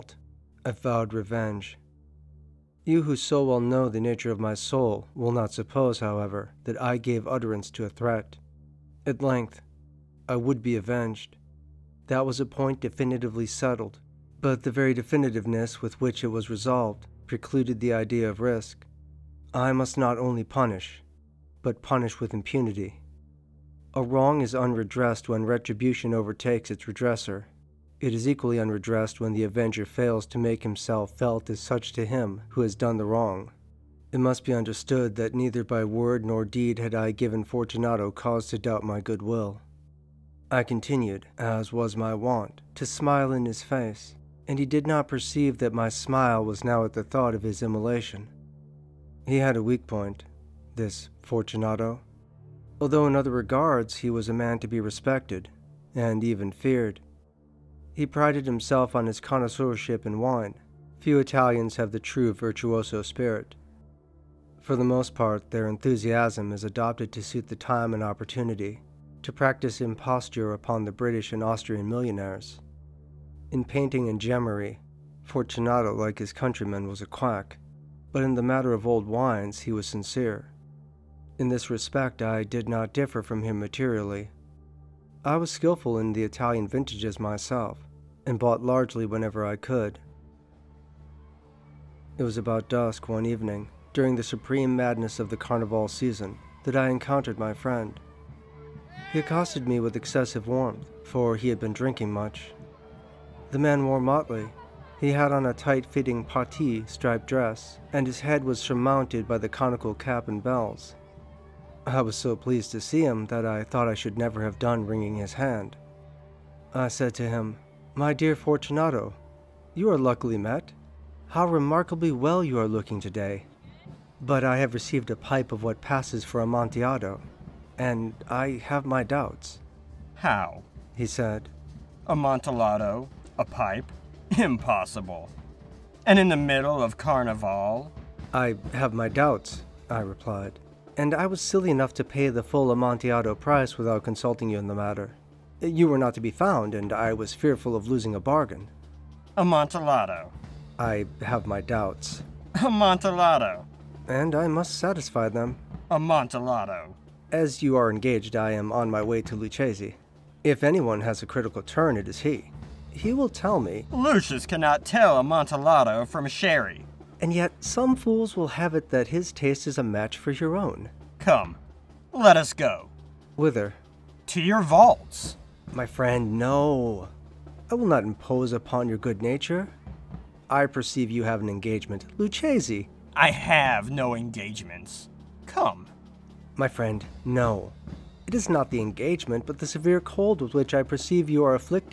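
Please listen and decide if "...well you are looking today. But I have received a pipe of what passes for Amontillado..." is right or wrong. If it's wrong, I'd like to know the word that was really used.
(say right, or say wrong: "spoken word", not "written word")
right.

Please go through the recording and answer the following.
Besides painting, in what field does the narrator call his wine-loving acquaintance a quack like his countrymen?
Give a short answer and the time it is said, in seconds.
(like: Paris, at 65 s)
gemmery, at 74 s.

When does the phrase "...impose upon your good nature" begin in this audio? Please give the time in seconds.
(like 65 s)
178 s.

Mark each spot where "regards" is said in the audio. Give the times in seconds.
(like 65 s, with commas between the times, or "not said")
53 s.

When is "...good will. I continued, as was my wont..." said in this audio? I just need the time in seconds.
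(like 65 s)
38 s.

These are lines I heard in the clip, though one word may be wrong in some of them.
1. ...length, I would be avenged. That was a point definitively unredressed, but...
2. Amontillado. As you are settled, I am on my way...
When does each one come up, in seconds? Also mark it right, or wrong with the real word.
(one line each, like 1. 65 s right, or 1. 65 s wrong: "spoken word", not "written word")
1. 9 s wrong: "settled", not "unredressed"
2. 155 s wrong: "engaged", not "settled".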